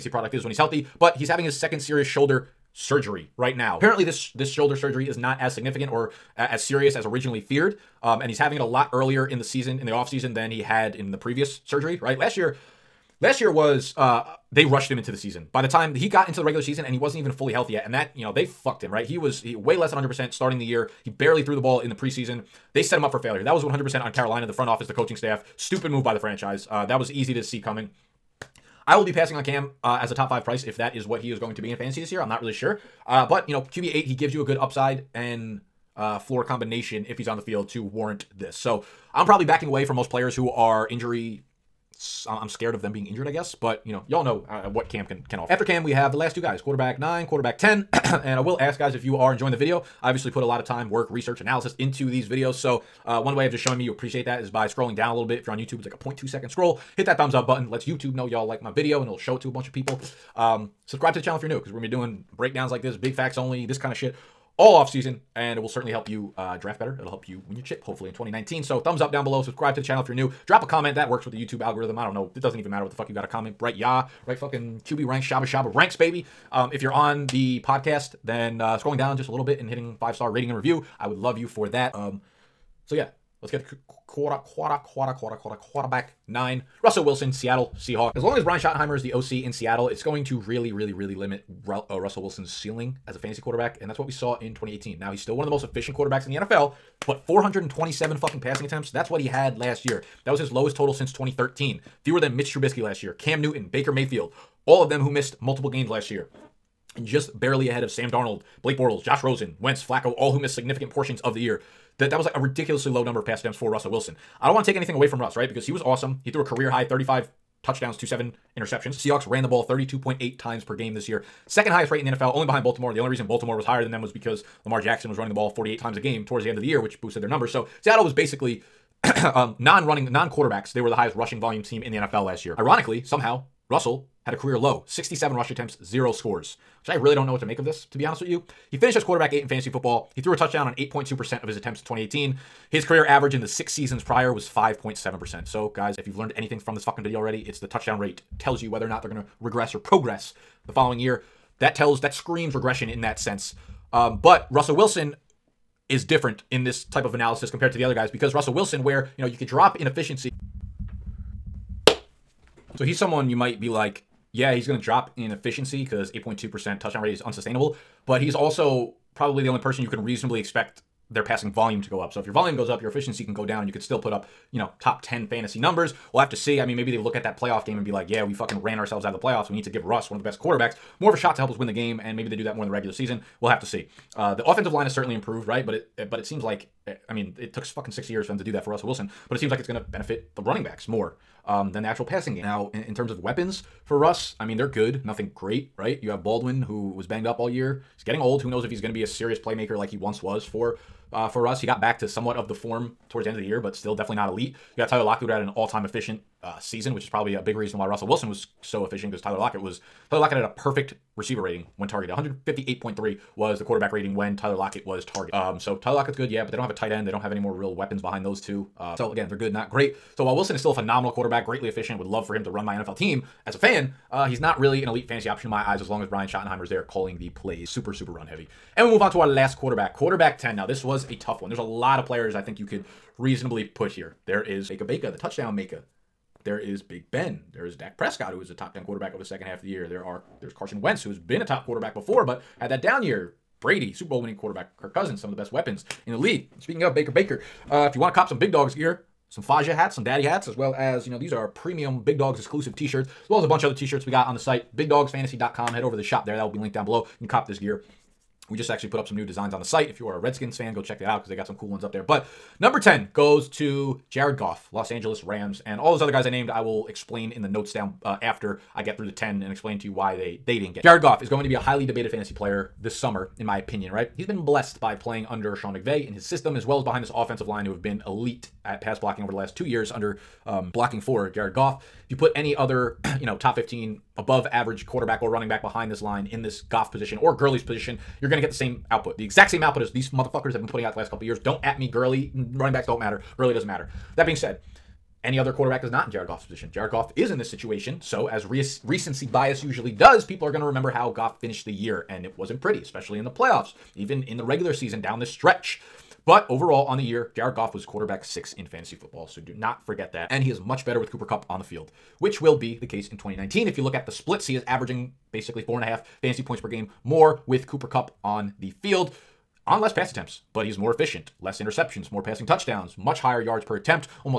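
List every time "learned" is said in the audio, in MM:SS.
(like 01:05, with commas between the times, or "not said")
02:26.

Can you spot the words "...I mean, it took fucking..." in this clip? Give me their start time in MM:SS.
03:07.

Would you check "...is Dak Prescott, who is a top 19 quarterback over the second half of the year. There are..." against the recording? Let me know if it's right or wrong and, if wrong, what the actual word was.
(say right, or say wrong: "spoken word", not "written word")
wrong: "10", not "19".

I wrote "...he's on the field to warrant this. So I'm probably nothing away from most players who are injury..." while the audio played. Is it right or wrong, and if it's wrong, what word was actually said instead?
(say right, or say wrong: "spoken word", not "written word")
wrong: "backing", not "nothing".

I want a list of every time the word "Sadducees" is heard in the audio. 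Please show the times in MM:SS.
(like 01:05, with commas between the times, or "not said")
not said.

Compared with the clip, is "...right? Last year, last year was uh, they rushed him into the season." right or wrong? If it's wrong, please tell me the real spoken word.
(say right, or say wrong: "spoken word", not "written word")
right.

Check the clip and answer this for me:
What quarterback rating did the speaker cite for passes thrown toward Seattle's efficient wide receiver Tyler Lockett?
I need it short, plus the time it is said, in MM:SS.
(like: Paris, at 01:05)
158.3, at 03:32.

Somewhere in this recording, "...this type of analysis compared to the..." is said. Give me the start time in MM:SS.
02:36.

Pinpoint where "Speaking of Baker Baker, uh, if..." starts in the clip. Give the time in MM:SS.
04:06.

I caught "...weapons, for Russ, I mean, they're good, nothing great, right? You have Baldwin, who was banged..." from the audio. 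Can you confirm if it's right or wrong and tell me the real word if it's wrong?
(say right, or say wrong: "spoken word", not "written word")
right.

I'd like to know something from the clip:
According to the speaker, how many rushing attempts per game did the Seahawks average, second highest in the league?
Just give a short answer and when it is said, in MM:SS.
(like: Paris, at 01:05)
32.8, at 01:59.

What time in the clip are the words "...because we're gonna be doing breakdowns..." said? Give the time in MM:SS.
01:01.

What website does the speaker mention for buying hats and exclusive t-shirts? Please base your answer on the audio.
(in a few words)
bigdogsfantasy.com.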